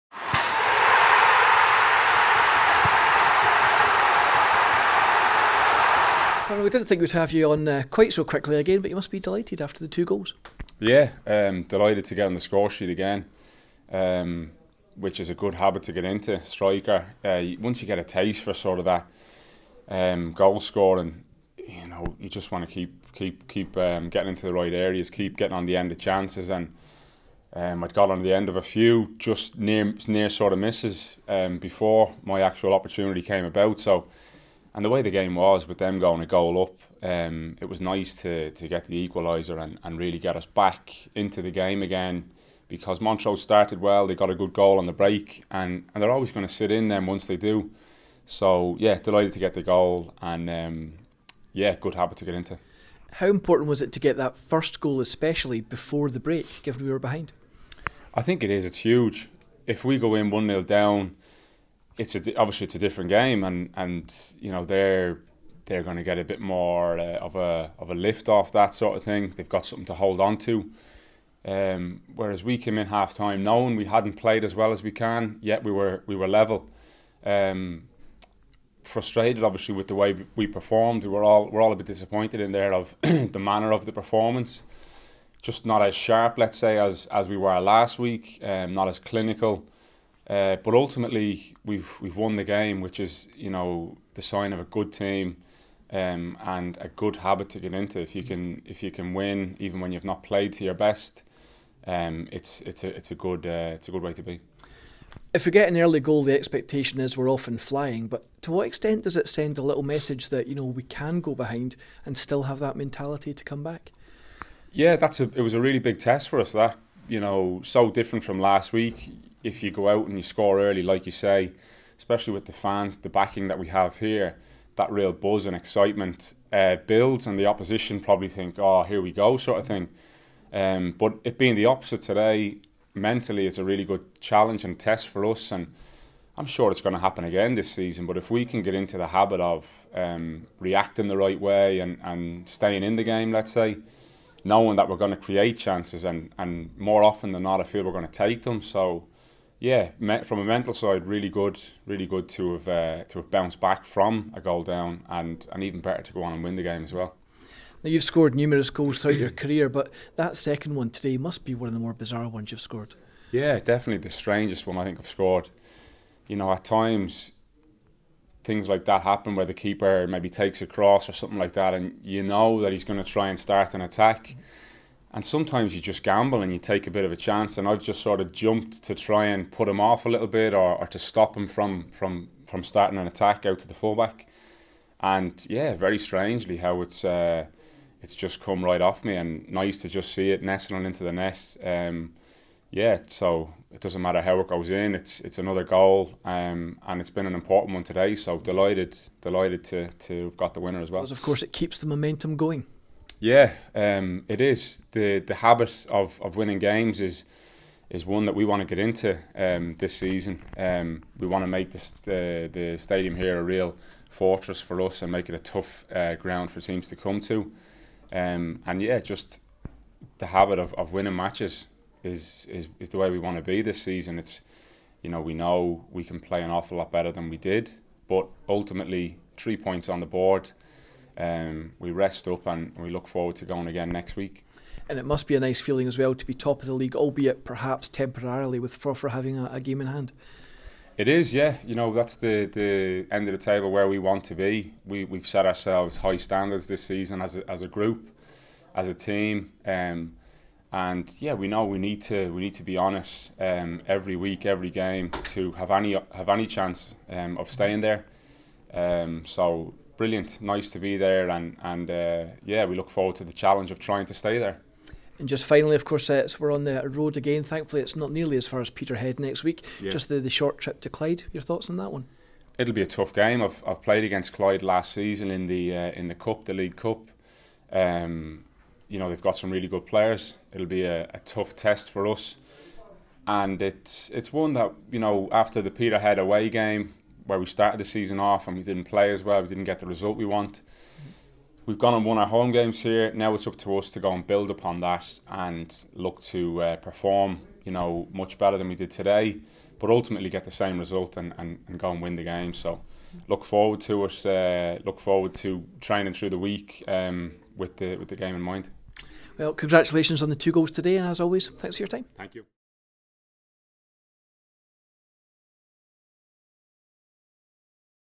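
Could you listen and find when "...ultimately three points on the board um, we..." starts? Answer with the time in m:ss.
3:48.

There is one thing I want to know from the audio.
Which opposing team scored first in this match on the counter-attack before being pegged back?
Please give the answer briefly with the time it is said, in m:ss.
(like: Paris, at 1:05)
Montrose, at 0:43.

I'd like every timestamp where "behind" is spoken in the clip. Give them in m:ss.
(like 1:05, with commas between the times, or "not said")
0:56, 1:51.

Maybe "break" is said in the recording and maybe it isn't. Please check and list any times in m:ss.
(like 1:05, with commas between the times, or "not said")
0:44, 0:56.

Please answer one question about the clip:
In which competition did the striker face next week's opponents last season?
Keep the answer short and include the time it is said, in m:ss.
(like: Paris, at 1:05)
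League Cup, at 4:36.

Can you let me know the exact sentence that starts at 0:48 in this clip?
So, yeah, delighted to get the goal, and um, yeah, good habit to get into.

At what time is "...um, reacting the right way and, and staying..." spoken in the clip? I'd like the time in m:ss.
2:19.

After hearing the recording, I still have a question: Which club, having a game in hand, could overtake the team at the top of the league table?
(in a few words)
Forfar.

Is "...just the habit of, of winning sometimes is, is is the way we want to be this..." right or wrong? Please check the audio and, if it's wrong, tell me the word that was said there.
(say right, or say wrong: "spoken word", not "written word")
wrong: "matches", not "sometimes".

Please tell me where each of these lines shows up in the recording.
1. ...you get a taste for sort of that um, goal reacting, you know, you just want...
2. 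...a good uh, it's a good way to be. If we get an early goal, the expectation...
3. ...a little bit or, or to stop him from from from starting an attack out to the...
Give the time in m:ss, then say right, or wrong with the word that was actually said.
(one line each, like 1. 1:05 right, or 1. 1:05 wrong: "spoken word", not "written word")
1. 0:17 wrong: "scoring", not "reacting"
2. 1:43 right
3. 3:00 right.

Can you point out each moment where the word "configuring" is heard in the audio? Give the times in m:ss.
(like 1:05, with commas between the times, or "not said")
not said.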